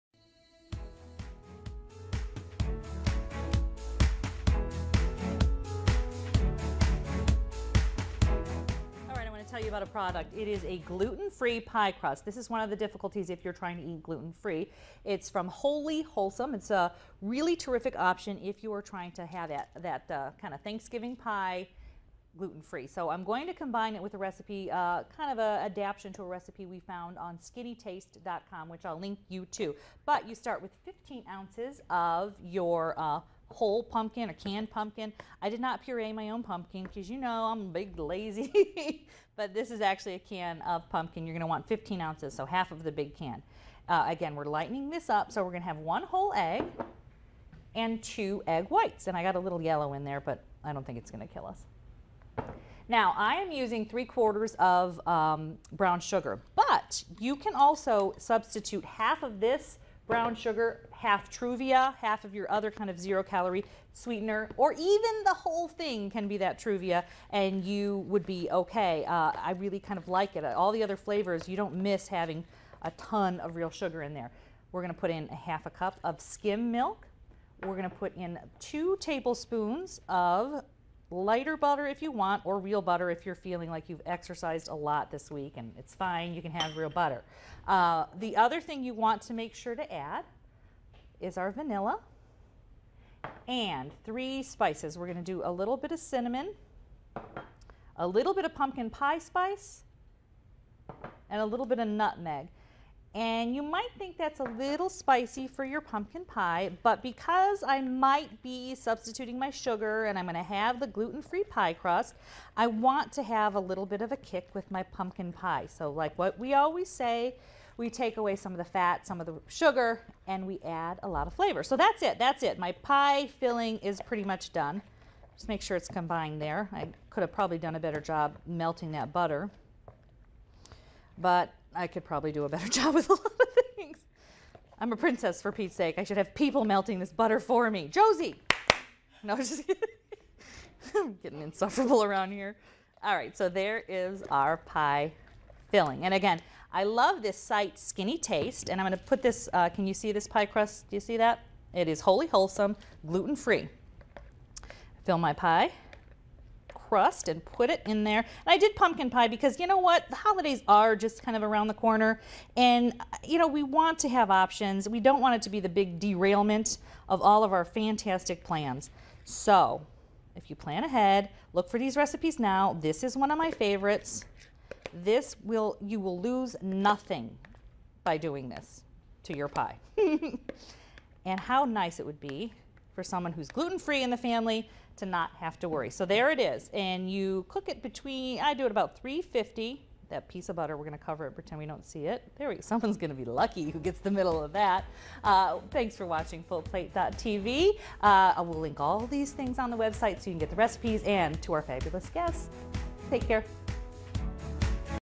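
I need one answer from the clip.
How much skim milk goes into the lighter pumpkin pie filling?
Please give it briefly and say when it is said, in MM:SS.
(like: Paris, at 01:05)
half a cup, at 01:15.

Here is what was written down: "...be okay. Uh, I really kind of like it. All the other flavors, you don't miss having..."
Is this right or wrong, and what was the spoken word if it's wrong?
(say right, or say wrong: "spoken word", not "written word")
right.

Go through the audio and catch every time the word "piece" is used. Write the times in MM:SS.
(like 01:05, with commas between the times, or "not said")
03:10.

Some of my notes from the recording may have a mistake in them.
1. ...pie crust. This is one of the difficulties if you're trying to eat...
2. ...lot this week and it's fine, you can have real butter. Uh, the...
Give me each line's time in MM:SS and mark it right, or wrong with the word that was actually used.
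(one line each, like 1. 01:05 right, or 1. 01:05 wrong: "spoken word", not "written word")
1. 00:11 right
2. 01:24 right.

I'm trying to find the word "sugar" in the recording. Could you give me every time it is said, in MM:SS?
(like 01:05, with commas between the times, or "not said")
00:56, 01:00, 01:13, 01:49, 01:59.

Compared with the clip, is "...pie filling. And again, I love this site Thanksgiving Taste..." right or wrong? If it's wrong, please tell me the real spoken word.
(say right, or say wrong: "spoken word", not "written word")
wrong: "Skinny", not "Thanksgiving".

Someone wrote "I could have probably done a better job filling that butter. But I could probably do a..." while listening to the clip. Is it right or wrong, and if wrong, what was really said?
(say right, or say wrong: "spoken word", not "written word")
wrong: "melting", not "filling".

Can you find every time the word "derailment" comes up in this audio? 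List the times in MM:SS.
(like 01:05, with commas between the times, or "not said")
02:46.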